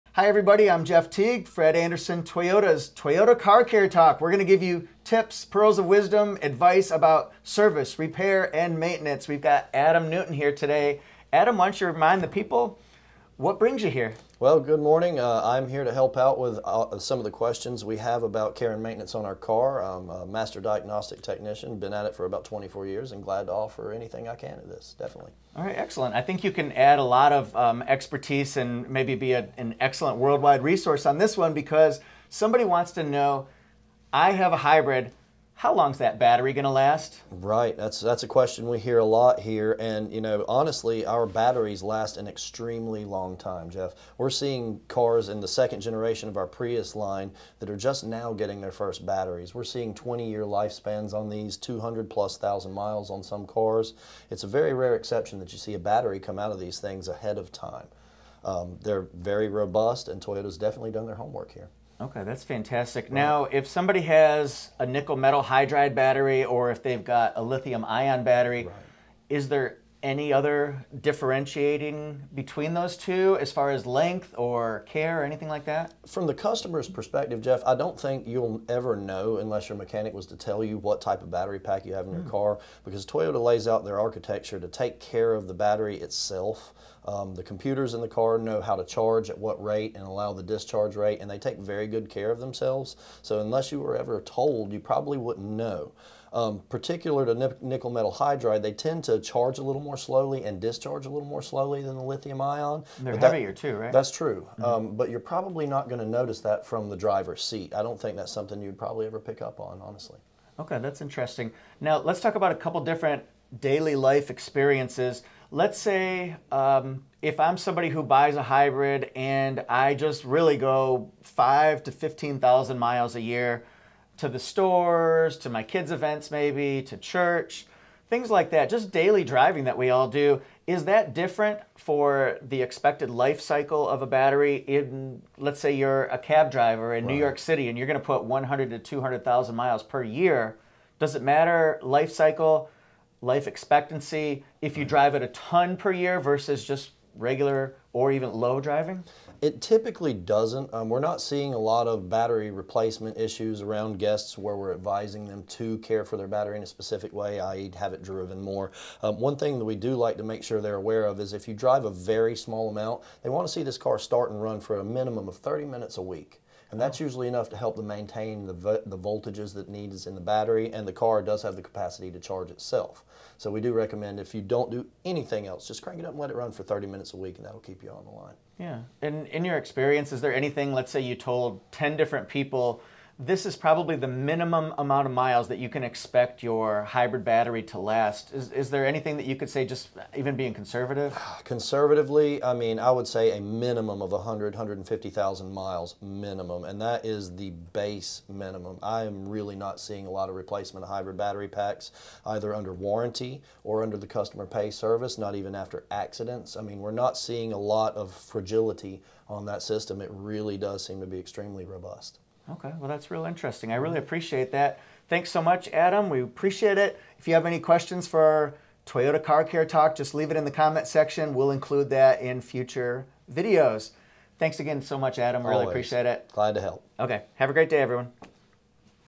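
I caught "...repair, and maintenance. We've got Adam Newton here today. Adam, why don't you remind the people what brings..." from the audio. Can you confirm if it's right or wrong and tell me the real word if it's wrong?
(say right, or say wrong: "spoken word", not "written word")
right.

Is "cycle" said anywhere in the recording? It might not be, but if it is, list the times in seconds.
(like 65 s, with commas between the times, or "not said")
133 s, 142 s.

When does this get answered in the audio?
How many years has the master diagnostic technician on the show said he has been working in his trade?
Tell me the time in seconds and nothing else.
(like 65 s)
22 s.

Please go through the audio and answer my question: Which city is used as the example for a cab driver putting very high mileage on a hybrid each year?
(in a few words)
New York City.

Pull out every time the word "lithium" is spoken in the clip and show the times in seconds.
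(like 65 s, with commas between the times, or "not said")
67 s, 102 s.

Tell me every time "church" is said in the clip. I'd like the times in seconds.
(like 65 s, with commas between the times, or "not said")
126 s.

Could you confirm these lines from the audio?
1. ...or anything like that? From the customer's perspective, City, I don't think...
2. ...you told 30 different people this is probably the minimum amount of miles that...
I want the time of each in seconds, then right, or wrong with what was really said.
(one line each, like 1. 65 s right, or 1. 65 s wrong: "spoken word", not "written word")
1. 75 s wrong: "Jeff", not "City"
2. 181 s wrong: "10", not "30".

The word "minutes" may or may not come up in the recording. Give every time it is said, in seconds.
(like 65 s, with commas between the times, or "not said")
165 s, 176 s.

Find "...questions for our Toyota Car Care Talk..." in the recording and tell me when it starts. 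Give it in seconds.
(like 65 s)
217 s.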